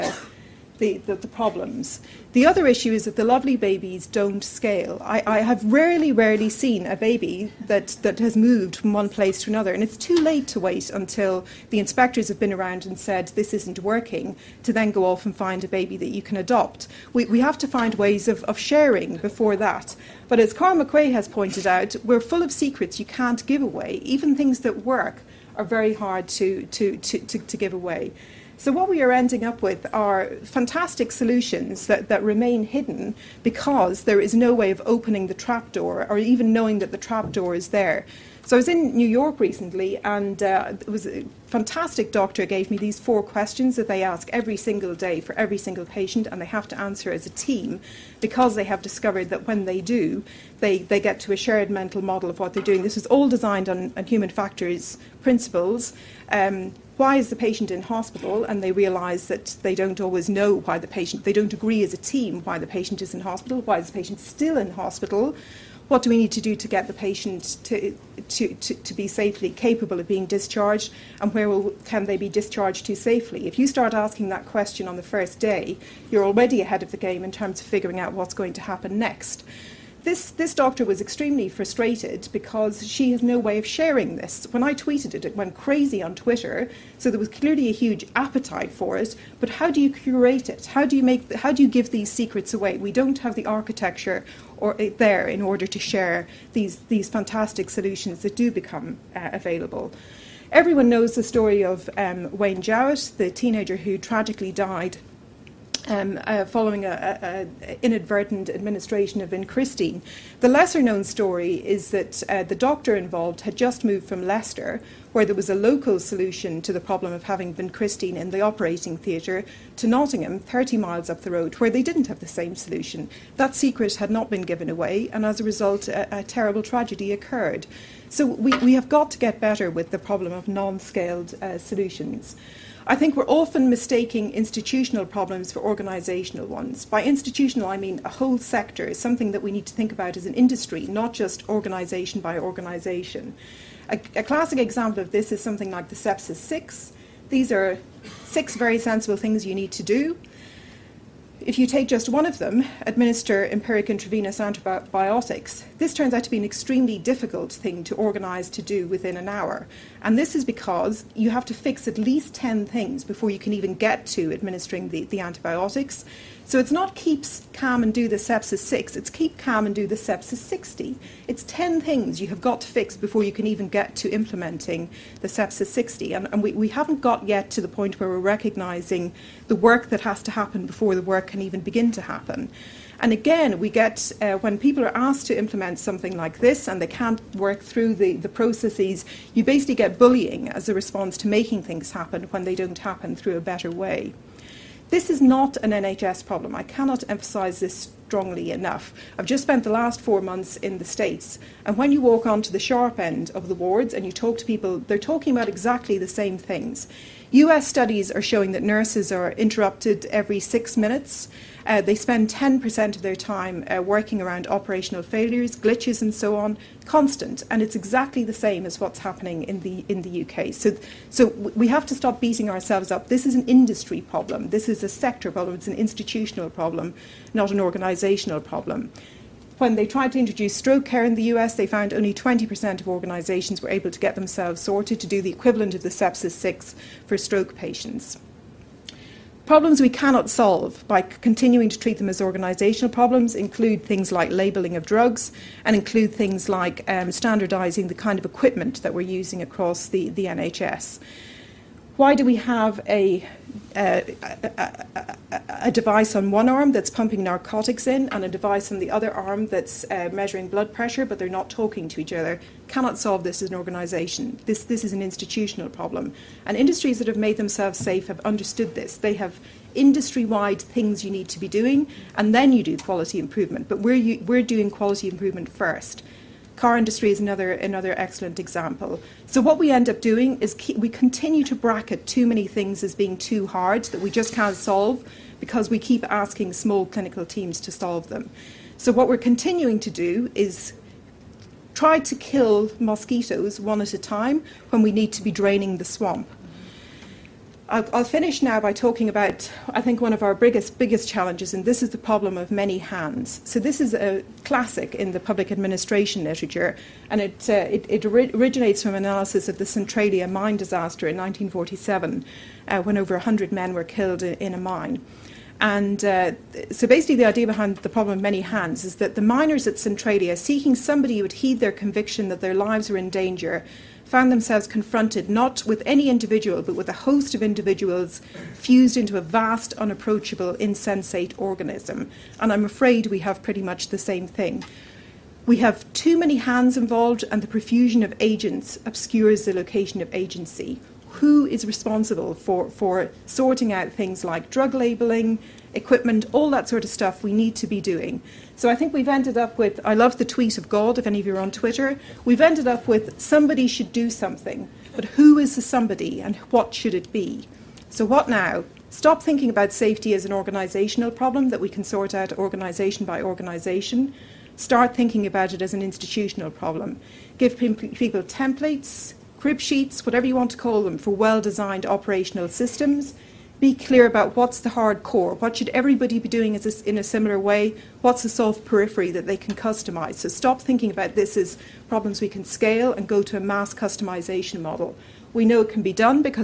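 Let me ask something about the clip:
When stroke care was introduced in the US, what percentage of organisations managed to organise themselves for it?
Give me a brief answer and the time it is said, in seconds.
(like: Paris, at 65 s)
20%, at 232 s.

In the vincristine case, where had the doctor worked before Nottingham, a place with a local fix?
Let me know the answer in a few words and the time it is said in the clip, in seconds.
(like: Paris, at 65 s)
Leicester, at 114 s.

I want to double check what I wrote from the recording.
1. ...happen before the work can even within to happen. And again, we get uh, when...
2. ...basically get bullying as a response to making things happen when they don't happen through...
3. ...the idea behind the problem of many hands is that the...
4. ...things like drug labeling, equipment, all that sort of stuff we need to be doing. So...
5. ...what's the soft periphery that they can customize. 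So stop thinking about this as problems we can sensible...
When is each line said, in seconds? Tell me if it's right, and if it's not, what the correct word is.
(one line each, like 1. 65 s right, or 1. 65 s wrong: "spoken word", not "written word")
1. 180 s wrong: "begin", not "within"
2. 189 s right
3. 317 s right
4. 343 s right
5. 378 s wrong: "scale", not "sensible".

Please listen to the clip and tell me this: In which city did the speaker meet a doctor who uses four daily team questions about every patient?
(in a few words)
New York.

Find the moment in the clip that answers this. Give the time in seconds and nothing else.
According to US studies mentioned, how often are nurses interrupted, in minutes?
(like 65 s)
210 s.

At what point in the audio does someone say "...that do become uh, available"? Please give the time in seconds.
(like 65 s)
98 s.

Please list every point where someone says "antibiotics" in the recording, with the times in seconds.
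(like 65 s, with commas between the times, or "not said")
154 s, 165 s.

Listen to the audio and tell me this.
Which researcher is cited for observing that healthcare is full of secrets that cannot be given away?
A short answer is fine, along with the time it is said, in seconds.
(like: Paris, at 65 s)
Carl Macrae, at 20 s.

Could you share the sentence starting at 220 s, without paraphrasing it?
So, so we have to stop beating ourselves up.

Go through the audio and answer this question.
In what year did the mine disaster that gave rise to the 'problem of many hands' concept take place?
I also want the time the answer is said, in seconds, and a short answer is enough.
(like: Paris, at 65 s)
1947, at 311 s.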